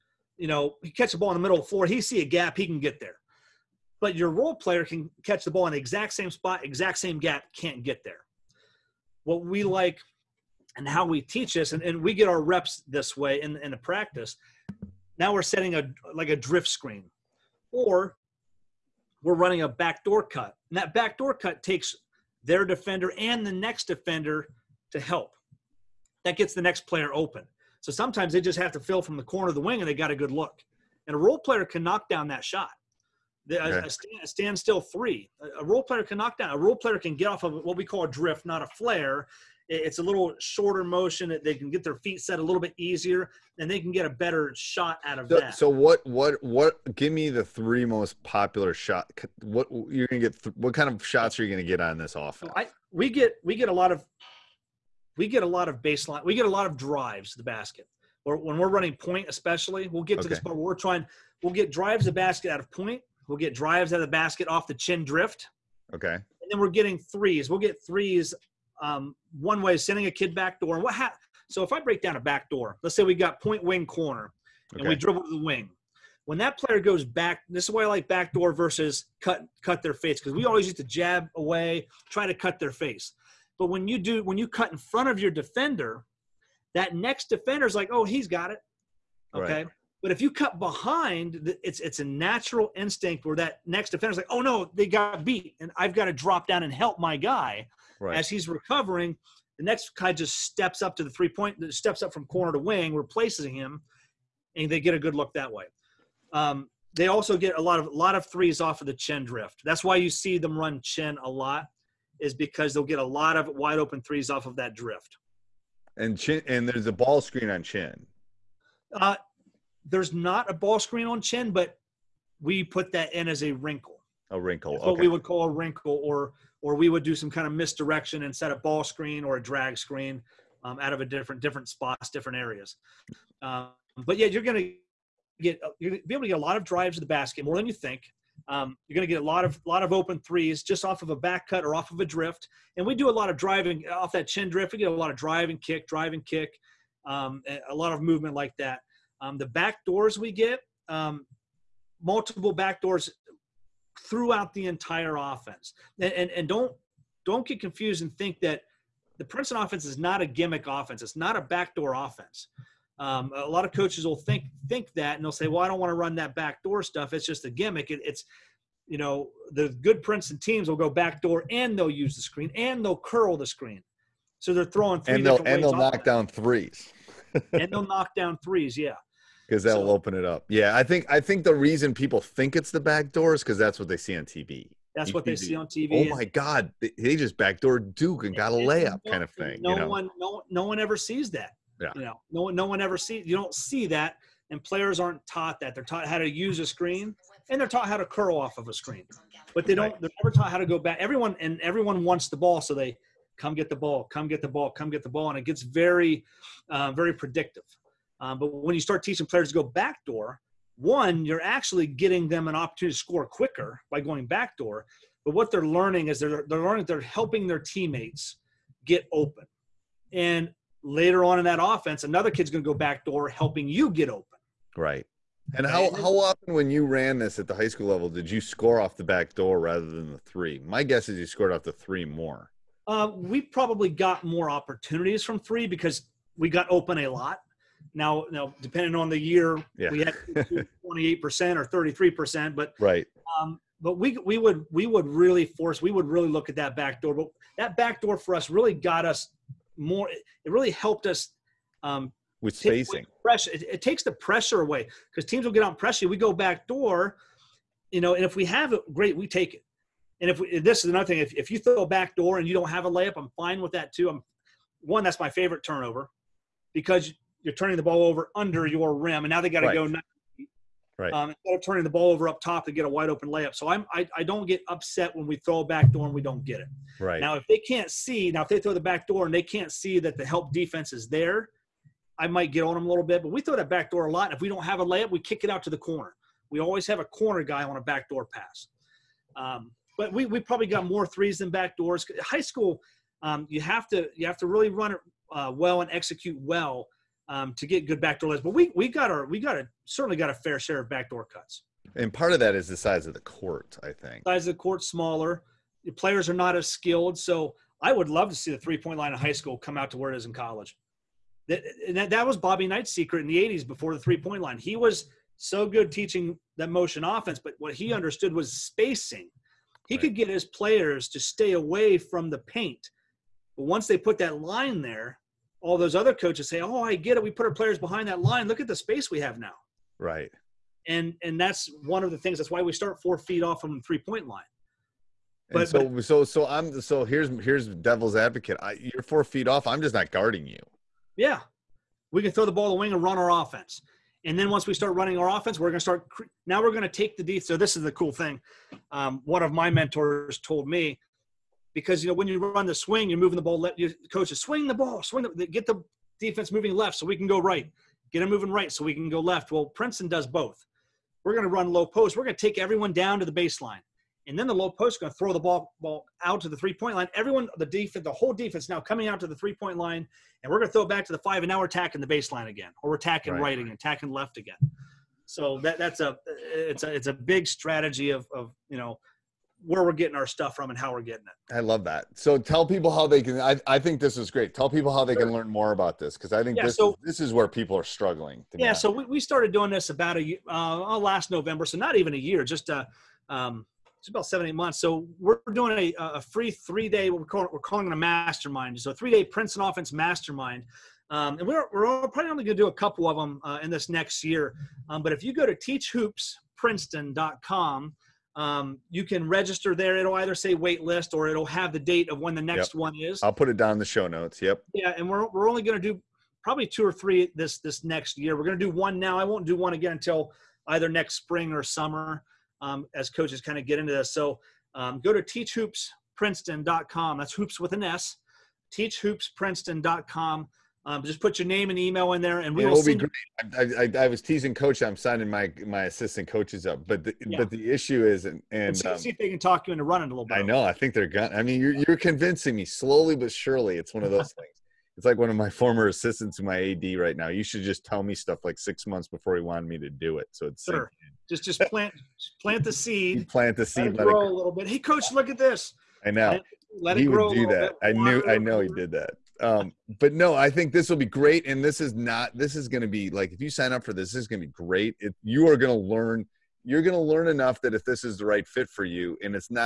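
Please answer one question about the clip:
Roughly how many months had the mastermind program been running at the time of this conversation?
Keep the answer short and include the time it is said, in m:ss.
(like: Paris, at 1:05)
7 or 8 months, at 6:34.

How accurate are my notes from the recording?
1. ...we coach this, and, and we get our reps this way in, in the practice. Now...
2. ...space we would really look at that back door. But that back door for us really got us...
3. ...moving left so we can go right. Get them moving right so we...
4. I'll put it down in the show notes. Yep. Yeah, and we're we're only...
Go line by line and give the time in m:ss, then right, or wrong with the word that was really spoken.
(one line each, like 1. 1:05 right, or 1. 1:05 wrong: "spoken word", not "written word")
1. 0:11 wrong: "teach", not "coach"
2. 4:05 wrong: "force", not "space"
3. 5:56 right
4. 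6:53 right.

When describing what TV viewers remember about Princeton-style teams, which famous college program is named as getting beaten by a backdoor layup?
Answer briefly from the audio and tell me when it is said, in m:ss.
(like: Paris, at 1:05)
Duke, at 3:07.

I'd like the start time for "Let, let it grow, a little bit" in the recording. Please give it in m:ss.
7:33.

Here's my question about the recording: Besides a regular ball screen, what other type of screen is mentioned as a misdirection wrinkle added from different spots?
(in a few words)
drag screen.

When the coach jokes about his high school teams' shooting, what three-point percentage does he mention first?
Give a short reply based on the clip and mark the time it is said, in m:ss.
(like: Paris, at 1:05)
28 percent, at 4:00.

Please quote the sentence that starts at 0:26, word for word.
That gets the next player open.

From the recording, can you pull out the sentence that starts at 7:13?
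I, I, I, was teasing coach.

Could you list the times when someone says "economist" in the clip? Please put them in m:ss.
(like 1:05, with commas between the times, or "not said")
not said.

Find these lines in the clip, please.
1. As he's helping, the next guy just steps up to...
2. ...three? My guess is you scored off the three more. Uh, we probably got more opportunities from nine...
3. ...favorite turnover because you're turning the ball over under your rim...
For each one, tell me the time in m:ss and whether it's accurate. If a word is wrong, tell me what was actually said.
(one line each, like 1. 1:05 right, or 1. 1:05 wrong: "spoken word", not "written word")
1. 1:38 wrong: "recovering", not "helping"
2. 3:50 wrong: "three", not "nine"
3. 4:25 right.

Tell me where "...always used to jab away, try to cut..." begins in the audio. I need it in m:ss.
1:20.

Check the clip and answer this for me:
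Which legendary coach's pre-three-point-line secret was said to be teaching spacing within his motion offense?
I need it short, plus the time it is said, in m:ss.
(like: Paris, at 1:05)
Bobby Knight, at 5:12.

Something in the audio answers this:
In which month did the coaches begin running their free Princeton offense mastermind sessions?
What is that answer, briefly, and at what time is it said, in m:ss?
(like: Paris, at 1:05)
November, at 6:31.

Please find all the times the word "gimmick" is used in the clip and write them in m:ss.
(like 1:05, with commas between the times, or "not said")
2:40, 2:47.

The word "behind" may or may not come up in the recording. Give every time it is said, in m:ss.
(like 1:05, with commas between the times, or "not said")
1:30, 5:27.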